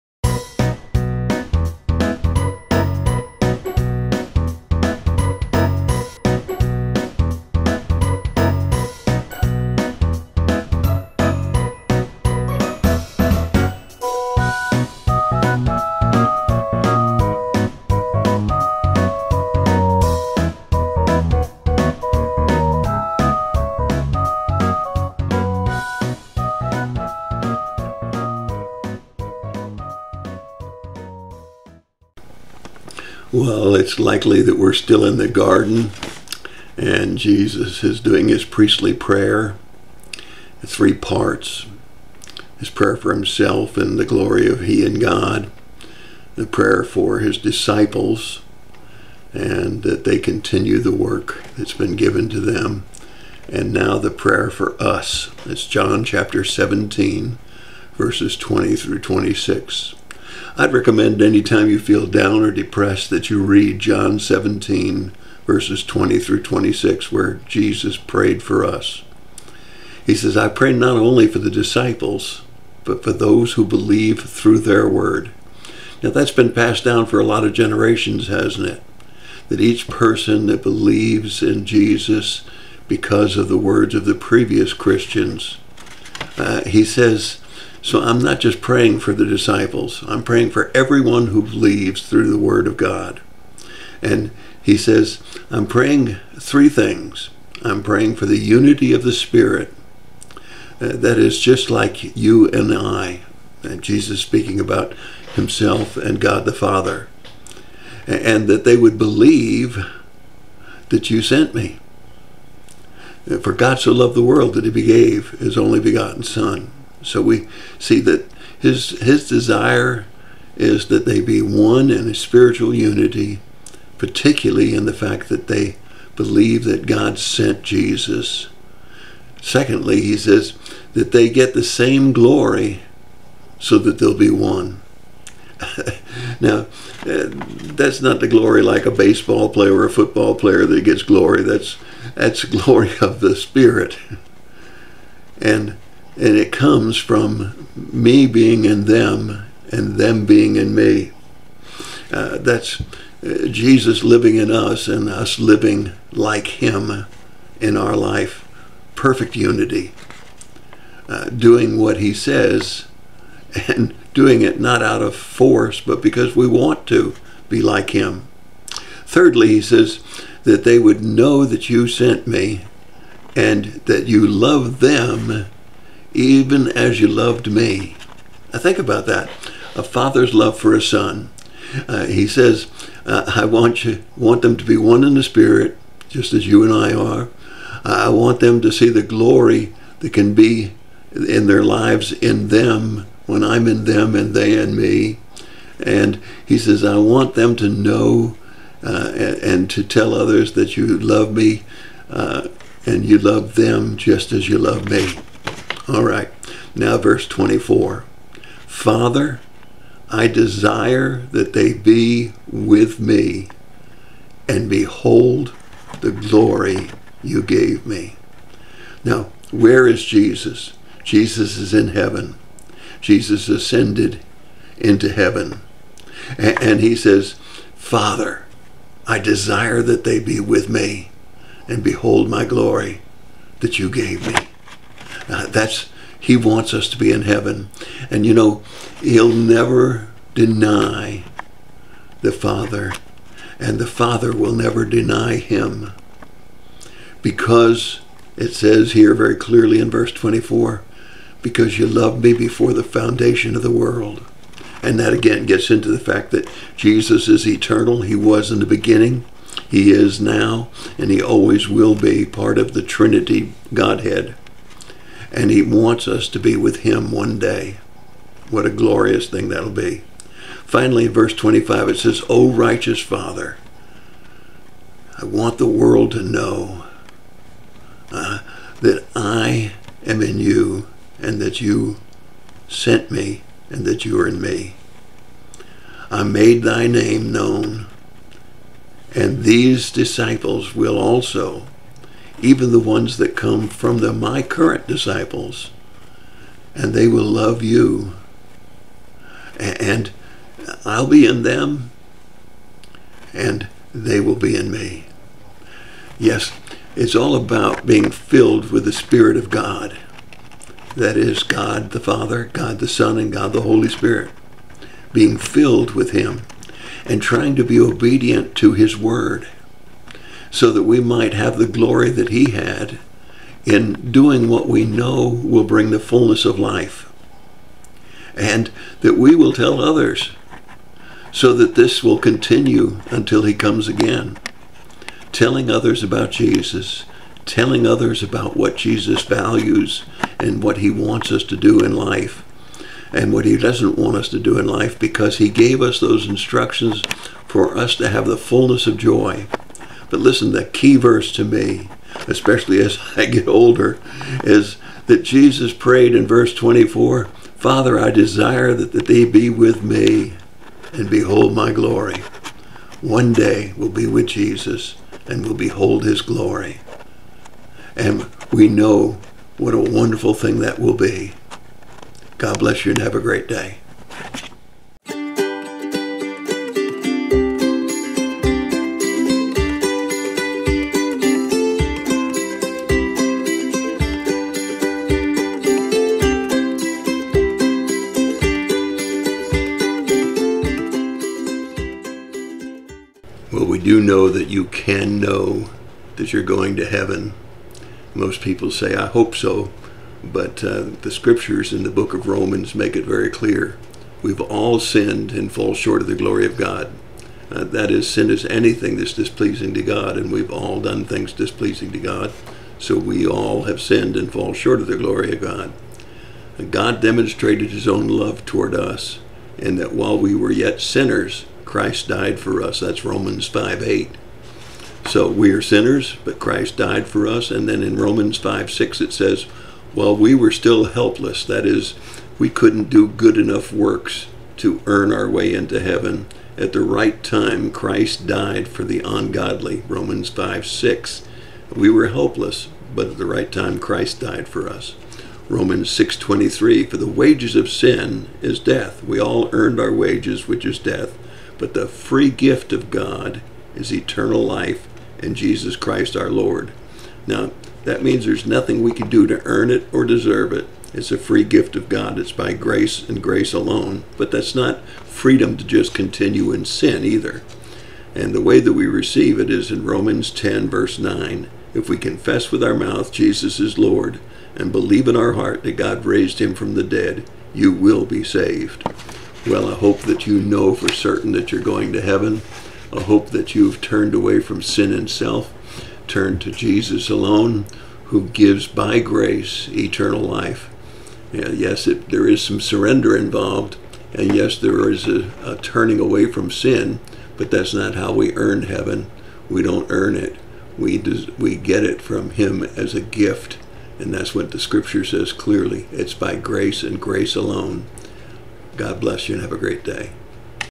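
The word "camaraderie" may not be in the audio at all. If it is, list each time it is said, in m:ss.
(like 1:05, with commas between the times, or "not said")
not said.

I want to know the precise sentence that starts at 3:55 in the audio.
Uh, that's He wants us to be in heaven.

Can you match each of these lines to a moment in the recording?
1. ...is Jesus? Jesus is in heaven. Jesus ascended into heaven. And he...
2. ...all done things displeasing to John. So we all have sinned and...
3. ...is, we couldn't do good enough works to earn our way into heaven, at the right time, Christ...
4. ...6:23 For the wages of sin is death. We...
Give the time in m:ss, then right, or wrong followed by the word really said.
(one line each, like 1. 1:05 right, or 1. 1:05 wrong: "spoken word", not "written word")
1. 3:39 right
2. 6:50 wrong: "God", not "John"
3. 7:11 right
4. 7:25 right.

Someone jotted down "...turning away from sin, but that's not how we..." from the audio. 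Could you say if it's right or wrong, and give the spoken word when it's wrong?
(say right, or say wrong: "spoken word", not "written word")
right.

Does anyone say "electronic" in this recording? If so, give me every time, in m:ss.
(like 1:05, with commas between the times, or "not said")
not said.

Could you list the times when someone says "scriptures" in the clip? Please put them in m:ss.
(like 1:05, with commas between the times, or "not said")
6:41, 8:24.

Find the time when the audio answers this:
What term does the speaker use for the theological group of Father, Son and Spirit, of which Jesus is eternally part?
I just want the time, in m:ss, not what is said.
4:22.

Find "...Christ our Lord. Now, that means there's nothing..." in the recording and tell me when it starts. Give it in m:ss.
7:35.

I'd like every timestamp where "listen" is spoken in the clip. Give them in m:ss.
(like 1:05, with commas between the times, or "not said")
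5:50.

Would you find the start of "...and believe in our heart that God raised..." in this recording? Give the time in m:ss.
7:54.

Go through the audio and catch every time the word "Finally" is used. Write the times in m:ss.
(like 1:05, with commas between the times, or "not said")
4:30.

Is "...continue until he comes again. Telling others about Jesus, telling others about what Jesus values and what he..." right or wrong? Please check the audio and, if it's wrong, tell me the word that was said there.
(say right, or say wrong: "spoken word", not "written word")
right.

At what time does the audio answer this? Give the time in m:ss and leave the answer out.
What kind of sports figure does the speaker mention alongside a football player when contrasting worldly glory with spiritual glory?
2:18.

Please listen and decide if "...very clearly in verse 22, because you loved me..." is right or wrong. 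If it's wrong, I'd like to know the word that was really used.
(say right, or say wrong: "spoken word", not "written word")
wrong: "24", not "22".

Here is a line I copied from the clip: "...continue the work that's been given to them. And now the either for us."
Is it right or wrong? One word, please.
wrong.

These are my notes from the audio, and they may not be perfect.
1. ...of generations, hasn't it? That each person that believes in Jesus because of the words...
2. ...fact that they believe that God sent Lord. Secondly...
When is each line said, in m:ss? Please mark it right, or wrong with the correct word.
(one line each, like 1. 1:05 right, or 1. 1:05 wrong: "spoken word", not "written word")
1. 1:17 right
2. 2:04 wrong: "Jesus", not "Lord".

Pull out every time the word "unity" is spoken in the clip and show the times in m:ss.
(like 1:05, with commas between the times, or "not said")
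1:38, 2:02, 2:39.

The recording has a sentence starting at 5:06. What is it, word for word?
Yes, it's all about being filled with the Spirit of God.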